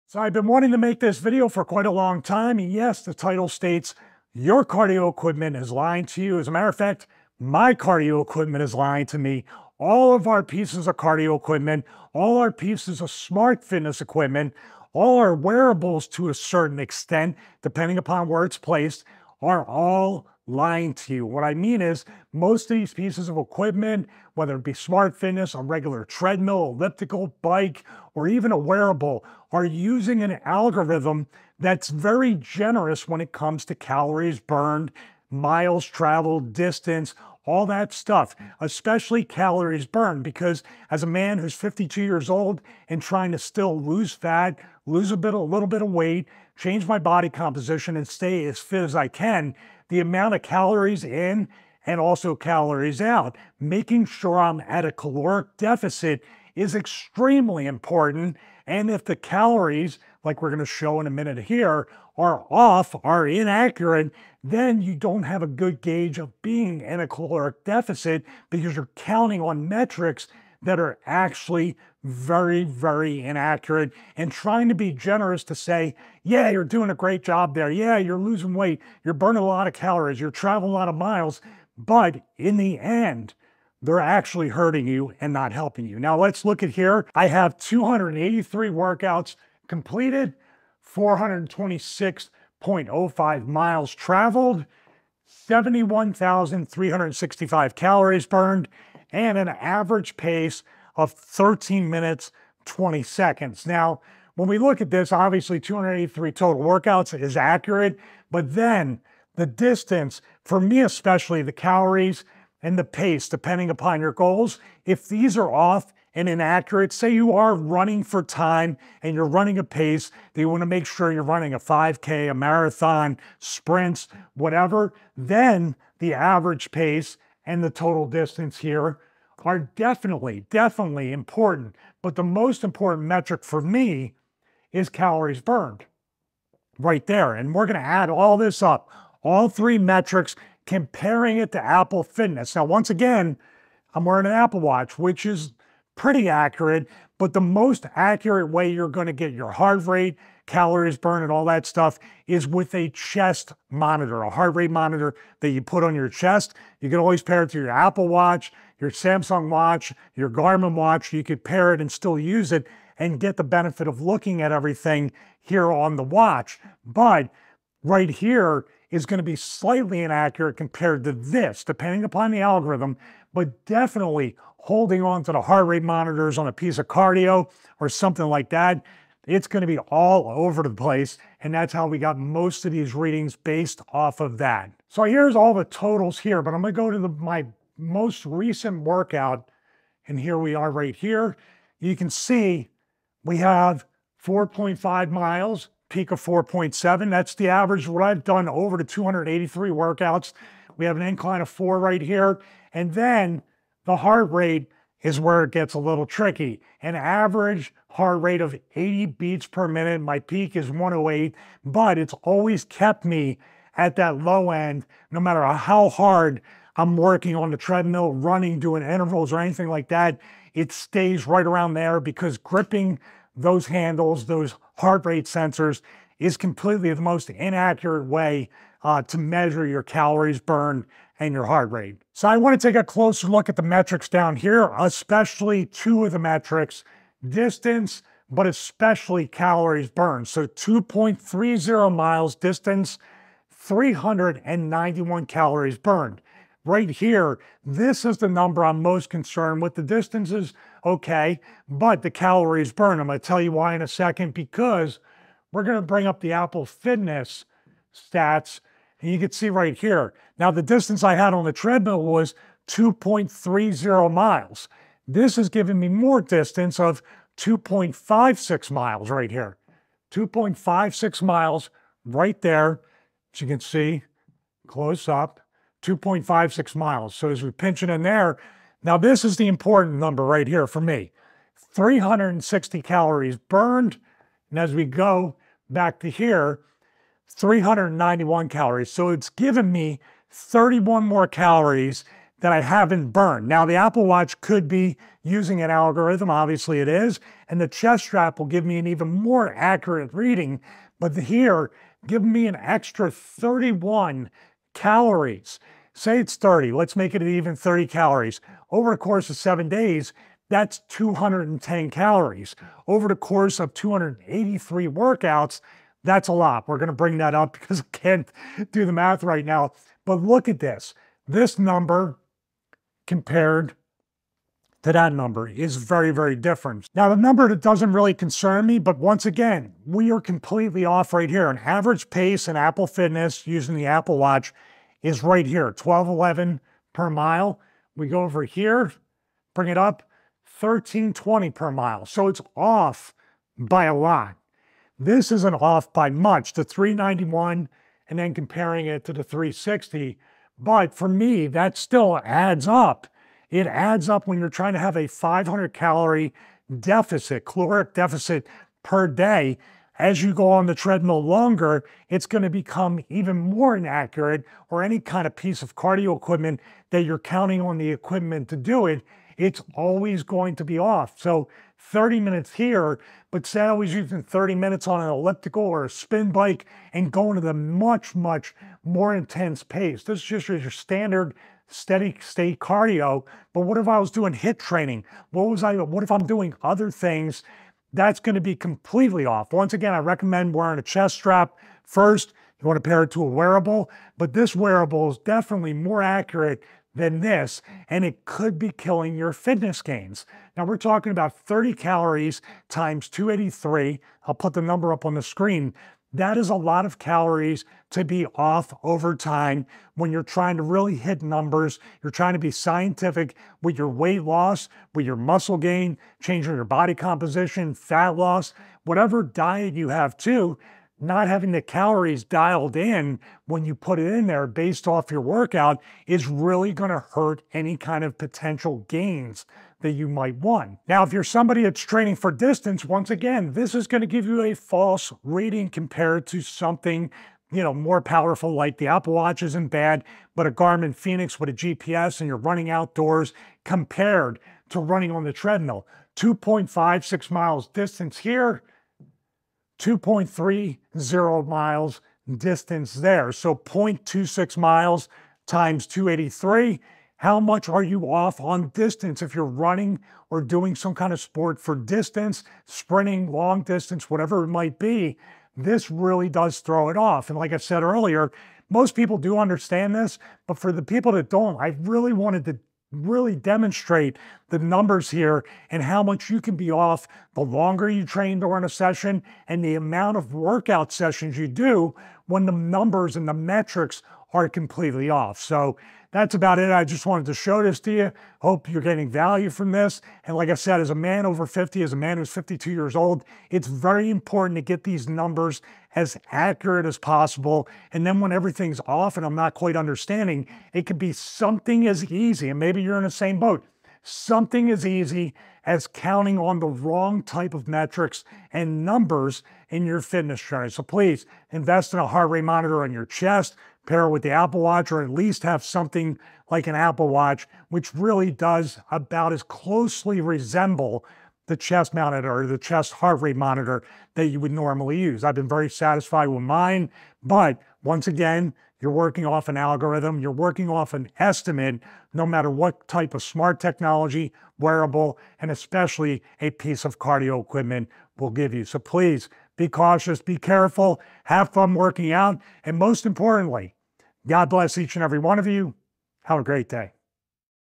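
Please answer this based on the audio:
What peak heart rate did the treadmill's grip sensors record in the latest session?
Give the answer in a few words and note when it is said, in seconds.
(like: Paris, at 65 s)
108, at 210 s.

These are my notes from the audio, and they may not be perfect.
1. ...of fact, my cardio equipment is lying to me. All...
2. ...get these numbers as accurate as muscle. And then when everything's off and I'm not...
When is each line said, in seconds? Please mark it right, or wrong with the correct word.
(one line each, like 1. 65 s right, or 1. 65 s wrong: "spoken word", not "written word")
1. 6 s right
2. 494 s wrong: "possible", not "muscle".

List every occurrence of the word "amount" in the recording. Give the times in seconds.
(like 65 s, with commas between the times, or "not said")
49 s, 479 s.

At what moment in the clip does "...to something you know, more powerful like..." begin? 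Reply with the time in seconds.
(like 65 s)
436 s.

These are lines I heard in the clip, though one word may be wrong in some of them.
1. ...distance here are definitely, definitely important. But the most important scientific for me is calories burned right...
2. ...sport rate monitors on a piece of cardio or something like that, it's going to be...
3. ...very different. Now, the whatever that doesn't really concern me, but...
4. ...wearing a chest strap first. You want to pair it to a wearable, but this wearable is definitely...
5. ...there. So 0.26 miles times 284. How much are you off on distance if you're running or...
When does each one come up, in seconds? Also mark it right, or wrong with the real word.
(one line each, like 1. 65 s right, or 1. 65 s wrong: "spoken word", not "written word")
1. 128 s wrong: "metric", not "scientific"
2. 175 s wrong: "heart", not "sport"
3. 326 s wrong: "number", not "whatever"
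4. 390 s right
5. 452 s wrong: "283", not "284".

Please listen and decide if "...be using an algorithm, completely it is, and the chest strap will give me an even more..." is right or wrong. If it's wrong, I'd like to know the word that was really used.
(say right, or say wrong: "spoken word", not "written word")
wrong: "obviously", not "completely".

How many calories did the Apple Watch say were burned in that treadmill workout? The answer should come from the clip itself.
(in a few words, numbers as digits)
360.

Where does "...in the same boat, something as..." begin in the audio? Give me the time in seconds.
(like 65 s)
502 s.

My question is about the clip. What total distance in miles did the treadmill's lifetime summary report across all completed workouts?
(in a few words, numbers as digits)
426.05.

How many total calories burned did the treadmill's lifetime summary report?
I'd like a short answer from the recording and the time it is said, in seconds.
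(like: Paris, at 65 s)
71,365, at 95 s.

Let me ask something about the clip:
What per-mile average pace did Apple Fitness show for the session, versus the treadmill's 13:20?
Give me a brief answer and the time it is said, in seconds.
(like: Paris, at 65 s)
12:11, at 335 s.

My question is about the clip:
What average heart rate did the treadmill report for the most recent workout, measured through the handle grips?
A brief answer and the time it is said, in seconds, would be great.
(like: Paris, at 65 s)
80 beats per minute, at 208 s.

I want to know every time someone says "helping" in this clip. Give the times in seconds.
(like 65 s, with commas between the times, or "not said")
85 s.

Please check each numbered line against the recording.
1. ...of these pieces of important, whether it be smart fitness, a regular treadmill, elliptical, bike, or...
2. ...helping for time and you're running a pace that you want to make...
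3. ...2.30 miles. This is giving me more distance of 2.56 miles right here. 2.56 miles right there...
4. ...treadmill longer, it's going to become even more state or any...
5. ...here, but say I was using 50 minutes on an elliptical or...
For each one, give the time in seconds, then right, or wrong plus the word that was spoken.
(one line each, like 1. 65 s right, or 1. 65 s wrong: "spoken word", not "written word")
1. 22 s wrong: "equipment", not "important"
2. 117 s wrong: "running", not "helping"
3. 262 s right
4. 360 s wrong: "inaccurate", not "state"
5. 372 s wrong: "30", not "50".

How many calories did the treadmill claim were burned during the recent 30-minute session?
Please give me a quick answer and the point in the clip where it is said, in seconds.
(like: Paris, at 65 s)
391, at 243 s.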